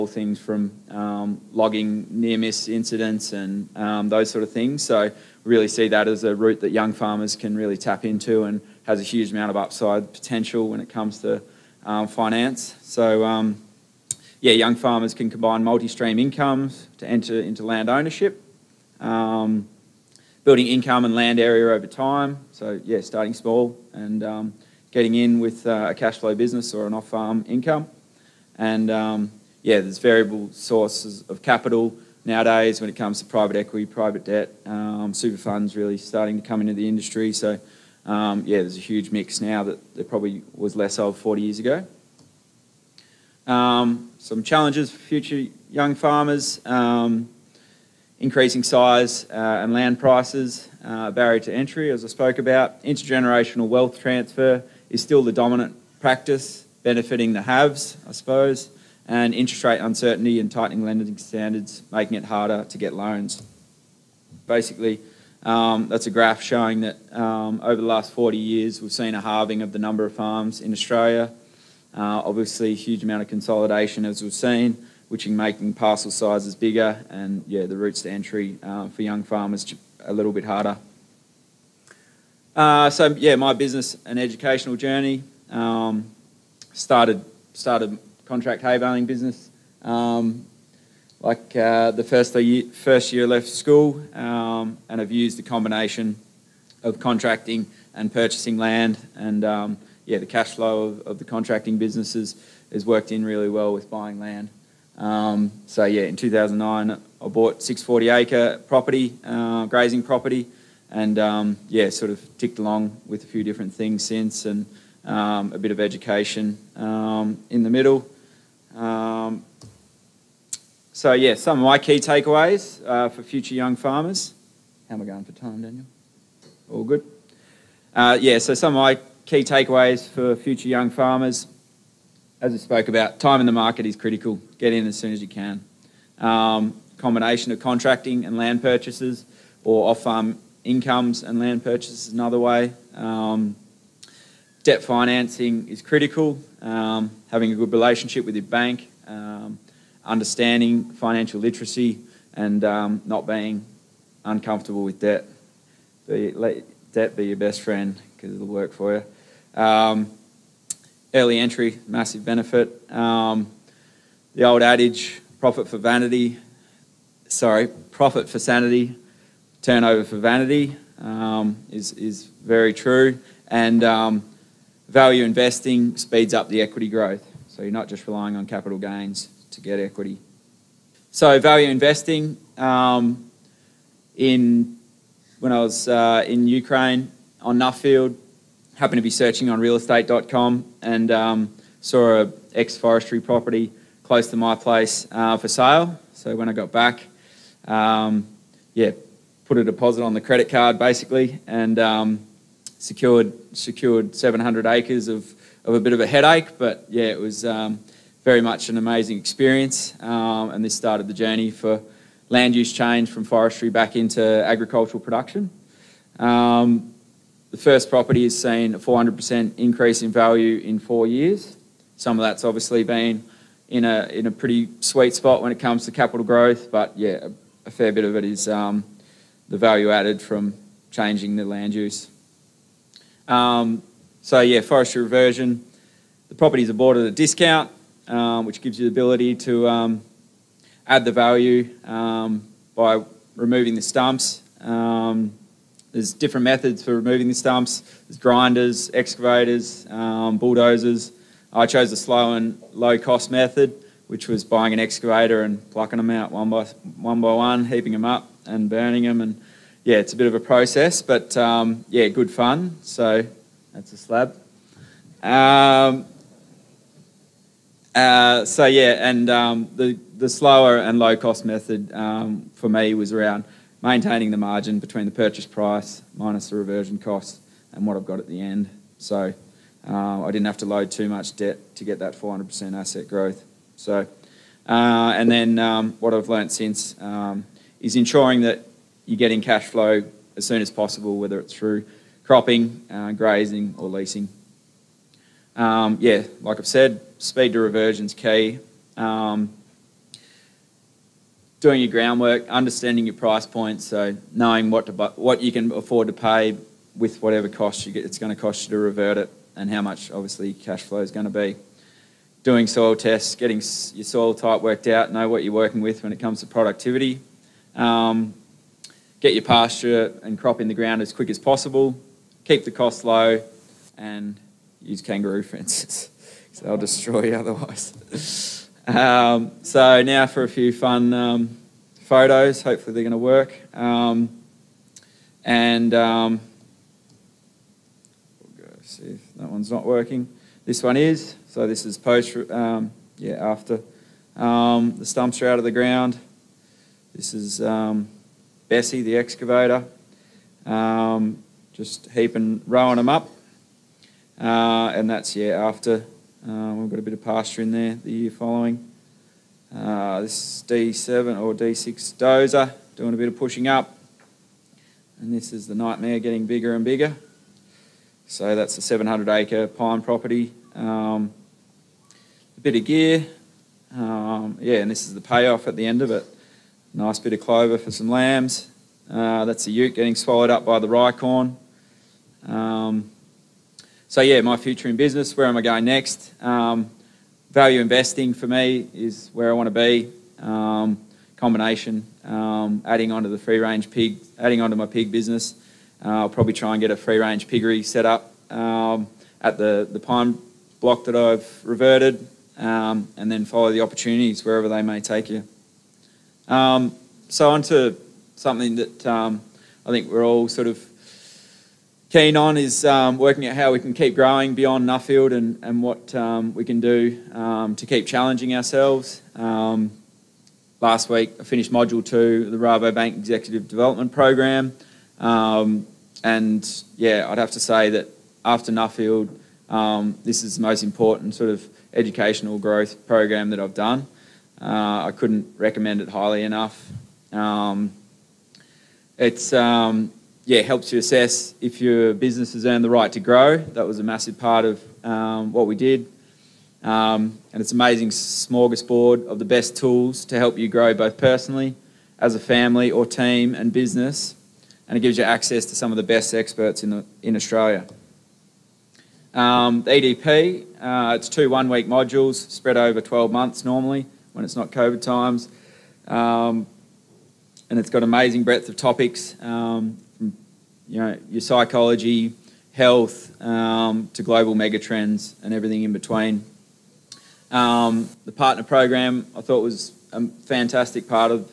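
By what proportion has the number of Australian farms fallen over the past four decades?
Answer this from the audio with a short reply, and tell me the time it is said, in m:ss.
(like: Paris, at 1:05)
halving, at 1:09.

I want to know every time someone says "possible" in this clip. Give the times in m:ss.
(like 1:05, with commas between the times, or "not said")
4:50, 5:21.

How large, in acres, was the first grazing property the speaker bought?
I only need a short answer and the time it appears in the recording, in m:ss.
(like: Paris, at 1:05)
640 acres, at 1:47.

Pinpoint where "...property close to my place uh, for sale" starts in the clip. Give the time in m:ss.
3:13.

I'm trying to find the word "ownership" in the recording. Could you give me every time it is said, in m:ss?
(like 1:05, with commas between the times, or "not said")
0:17.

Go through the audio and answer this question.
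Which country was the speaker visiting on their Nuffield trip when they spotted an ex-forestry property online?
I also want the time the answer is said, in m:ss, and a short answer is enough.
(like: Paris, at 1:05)
Ukraine, at 3:06.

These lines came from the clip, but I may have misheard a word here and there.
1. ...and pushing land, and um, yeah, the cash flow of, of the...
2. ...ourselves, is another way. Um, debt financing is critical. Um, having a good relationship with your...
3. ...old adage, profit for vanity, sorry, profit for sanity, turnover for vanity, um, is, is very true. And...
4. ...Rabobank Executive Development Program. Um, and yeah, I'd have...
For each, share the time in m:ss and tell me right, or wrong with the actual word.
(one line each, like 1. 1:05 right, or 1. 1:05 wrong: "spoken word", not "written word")
1. 1:37 wrong: "purchasing", not "pushing"
2. 2:21 wrong: "purchases", not "ourselves"
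3. 2:44 right
4. 7:02 right.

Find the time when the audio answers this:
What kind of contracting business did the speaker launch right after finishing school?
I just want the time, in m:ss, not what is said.
1:28.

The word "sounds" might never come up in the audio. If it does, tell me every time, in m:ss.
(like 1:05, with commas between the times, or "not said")
not said.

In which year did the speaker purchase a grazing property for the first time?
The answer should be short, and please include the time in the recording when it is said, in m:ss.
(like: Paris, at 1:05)
2009, at 1:46.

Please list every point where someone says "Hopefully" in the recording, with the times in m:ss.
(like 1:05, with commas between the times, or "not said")
5:32.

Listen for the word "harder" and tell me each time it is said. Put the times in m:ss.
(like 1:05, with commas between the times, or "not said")
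1:02, 1:20.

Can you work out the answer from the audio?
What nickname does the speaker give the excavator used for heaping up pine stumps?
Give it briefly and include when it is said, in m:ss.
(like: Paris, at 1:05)
Bessie, at 5:48.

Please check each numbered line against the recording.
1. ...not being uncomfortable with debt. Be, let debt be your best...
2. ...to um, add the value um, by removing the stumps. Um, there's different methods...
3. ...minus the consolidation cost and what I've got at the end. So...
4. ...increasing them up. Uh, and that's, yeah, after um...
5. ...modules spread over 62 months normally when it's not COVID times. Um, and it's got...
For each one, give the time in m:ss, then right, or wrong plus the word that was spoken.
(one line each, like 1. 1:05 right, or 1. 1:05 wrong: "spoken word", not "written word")
1. 2:33 right
2. 3:59 right
3. 4:36 wrong: "reversion", not "consolidation"
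4. 5:52 wrong: "rowing", not "increasing"
5. 7:41 wrong: "12", not "62".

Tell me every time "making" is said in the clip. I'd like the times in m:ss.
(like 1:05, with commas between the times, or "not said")
1:01, 1:15.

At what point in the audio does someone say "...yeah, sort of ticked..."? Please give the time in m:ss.
1:51.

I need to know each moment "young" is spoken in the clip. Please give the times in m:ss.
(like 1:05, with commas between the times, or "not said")
0:06, 0:14, 0:45, 1:19, 2:03, 2:10.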